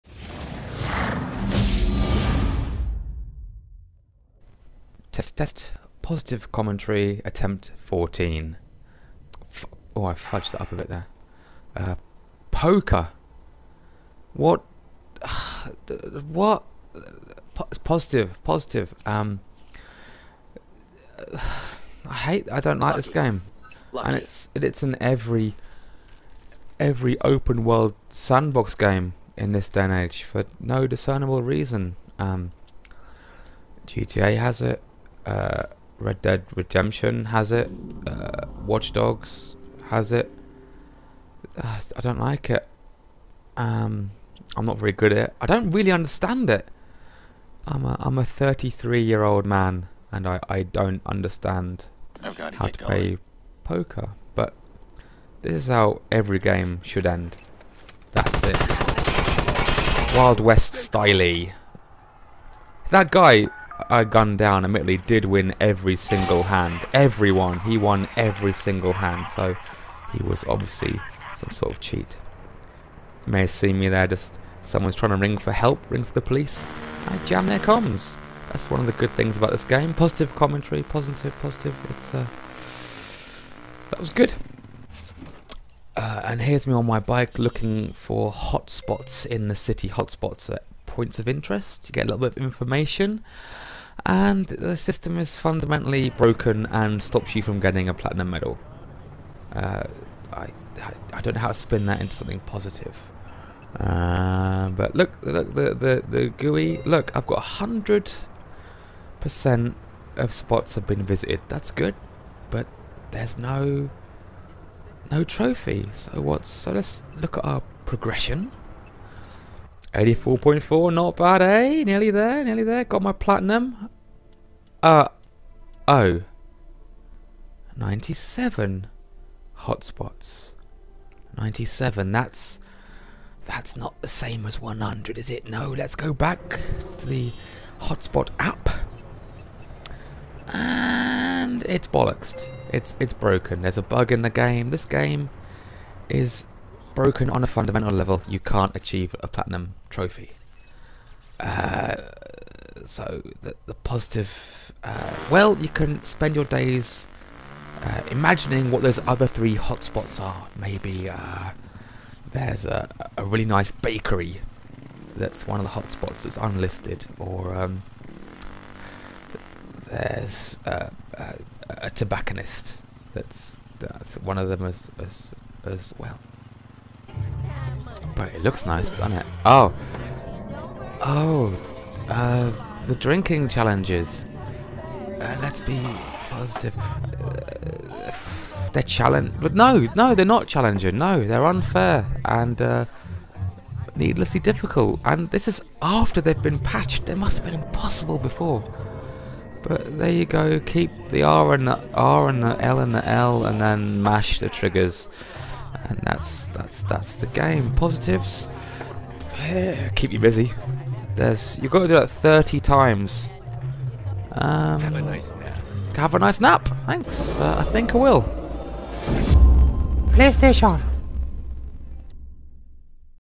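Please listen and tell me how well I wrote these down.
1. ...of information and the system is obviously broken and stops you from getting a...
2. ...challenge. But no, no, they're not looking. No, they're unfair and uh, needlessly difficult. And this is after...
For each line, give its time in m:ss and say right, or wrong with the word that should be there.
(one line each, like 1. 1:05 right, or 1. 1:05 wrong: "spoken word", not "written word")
1. 1:32 wrong: "fundamentally", not "obviously"
2. 3:08 wrong: "challenging", not "looking".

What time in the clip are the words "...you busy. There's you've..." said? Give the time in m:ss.
3:30.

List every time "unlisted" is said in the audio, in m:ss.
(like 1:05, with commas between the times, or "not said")
2:46.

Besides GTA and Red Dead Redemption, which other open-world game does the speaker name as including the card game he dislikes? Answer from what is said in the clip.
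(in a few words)
Watch Dogs.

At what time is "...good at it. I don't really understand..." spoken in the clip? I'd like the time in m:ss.
0:44.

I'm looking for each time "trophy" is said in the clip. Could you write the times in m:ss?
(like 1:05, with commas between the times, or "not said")
1:55, 2:29.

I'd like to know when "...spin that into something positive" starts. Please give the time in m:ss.
1:41.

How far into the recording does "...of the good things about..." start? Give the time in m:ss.
1:18.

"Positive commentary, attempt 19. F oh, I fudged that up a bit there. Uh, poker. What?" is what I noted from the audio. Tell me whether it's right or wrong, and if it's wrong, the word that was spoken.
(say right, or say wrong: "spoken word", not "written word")
wrong: "14", not "19".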